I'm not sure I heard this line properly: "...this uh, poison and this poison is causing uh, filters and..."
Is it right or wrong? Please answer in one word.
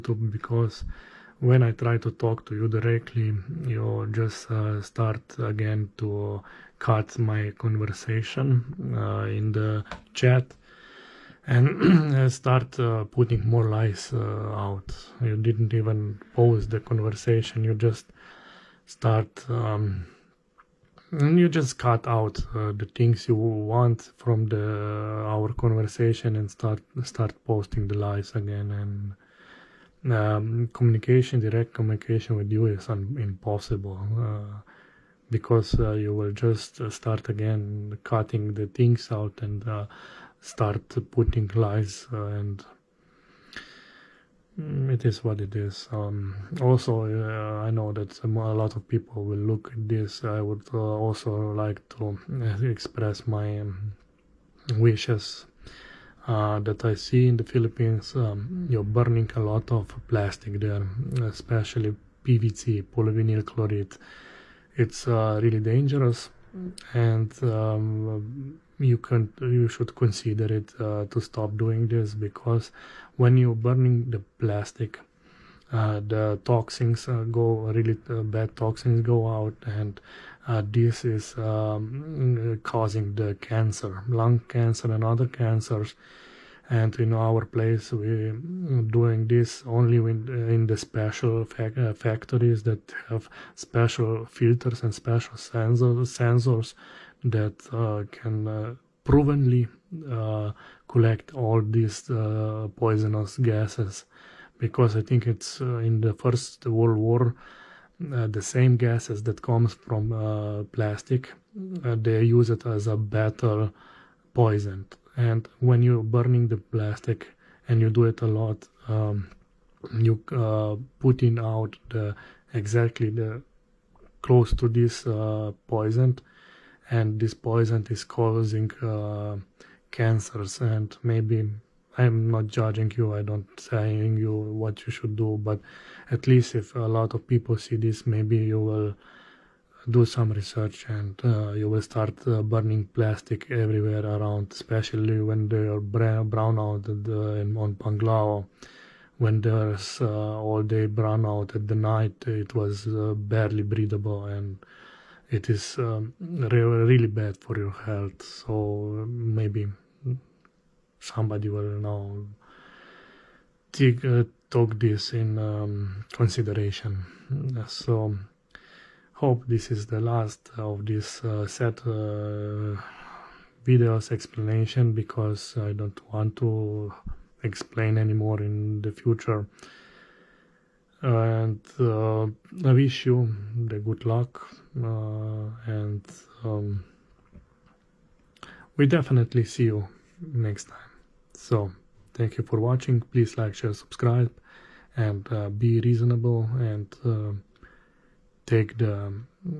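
wrong.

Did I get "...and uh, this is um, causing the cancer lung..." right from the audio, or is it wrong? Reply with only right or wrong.
right.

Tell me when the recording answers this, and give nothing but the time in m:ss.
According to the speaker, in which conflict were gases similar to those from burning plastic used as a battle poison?
1:46.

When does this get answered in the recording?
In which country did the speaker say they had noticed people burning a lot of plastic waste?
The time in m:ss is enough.
0:57.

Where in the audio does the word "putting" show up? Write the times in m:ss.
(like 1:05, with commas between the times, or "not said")
0:13, 0:41, 2:00.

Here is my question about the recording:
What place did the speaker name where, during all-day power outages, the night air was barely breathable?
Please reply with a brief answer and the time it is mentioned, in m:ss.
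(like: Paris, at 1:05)
Panglao, at 2:27.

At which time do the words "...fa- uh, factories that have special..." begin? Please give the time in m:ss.
1:31.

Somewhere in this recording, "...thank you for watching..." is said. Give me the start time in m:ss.
3:12.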